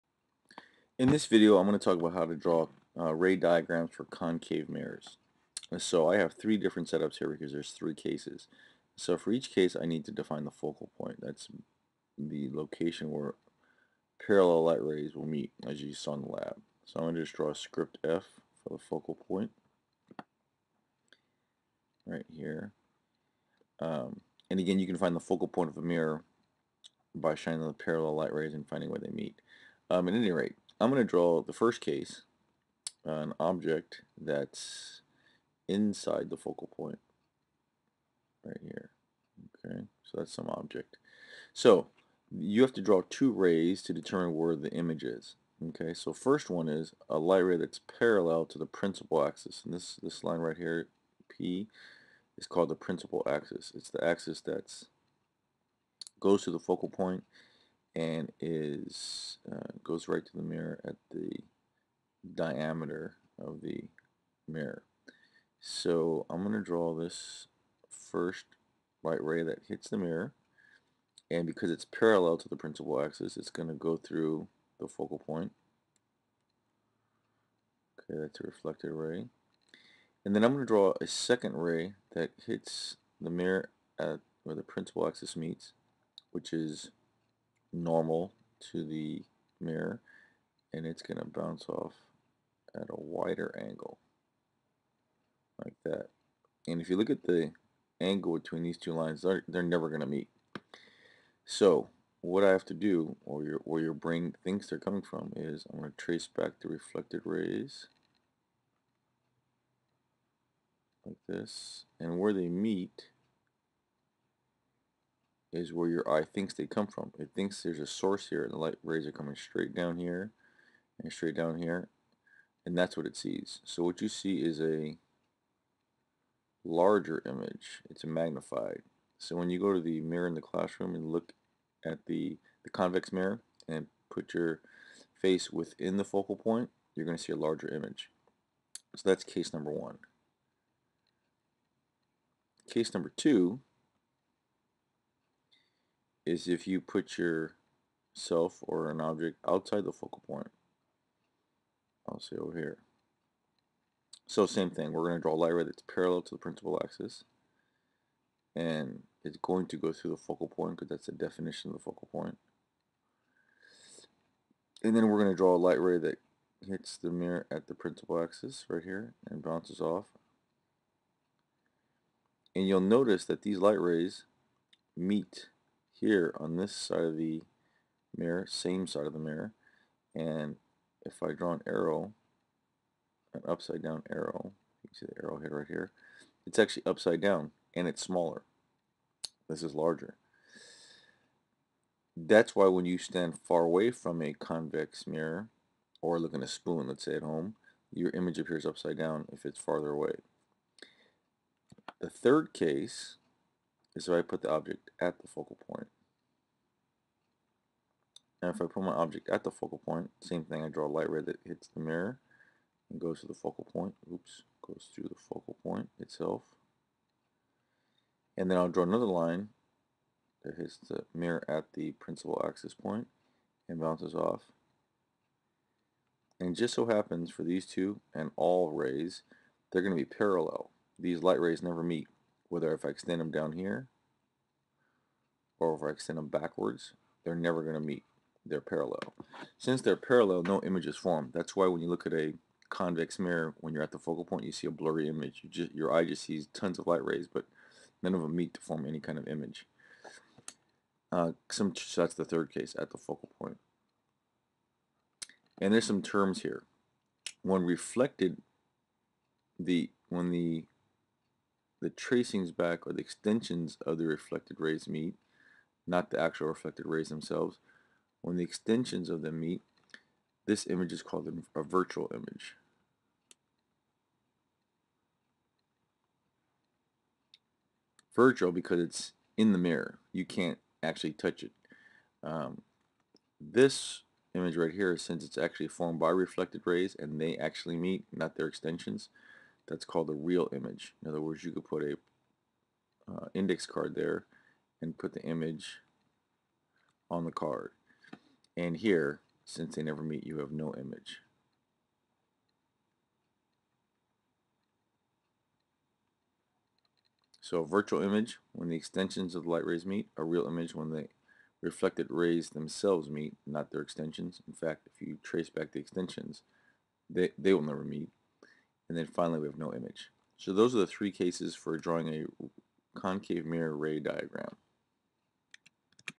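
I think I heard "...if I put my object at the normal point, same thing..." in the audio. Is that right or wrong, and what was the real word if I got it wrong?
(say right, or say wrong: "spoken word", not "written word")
wrong: "focal", not "normal".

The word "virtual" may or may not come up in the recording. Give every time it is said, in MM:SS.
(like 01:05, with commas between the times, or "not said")
04:31, 04:38, 05:07.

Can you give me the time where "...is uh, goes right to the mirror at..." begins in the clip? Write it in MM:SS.
00:58.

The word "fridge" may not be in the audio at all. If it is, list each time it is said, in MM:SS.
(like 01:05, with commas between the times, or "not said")
not said.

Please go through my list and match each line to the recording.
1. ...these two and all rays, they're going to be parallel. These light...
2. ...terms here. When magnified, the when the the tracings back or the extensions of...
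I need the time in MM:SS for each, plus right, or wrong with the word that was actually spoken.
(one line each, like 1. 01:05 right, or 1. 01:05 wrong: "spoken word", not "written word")
1. 03:47 right
2. 04:16 wrong: "reflected", not "magnified".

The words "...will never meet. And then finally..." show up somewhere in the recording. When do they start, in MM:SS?
05:17.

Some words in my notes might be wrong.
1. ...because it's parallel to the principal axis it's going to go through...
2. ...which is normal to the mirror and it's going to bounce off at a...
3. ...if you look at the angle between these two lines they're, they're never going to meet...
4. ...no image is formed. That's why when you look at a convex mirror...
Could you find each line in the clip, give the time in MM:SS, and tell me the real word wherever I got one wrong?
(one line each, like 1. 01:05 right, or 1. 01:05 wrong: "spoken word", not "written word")
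1. 01:11 right
2. 01:26 right
3. 01:36 right
4. 04:00 right.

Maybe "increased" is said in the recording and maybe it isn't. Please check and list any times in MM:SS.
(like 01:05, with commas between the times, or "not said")
not said.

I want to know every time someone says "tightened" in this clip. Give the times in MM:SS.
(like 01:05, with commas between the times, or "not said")
not said.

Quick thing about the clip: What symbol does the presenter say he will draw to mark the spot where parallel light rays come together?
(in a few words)
Script F.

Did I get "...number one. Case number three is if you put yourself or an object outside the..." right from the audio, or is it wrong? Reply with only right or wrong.
wrong.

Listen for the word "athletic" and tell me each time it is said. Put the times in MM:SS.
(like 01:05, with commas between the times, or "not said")
not said.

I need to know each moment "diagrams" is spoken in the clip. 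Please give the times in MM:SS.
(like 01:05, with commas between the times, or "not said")
00:03, 05:24.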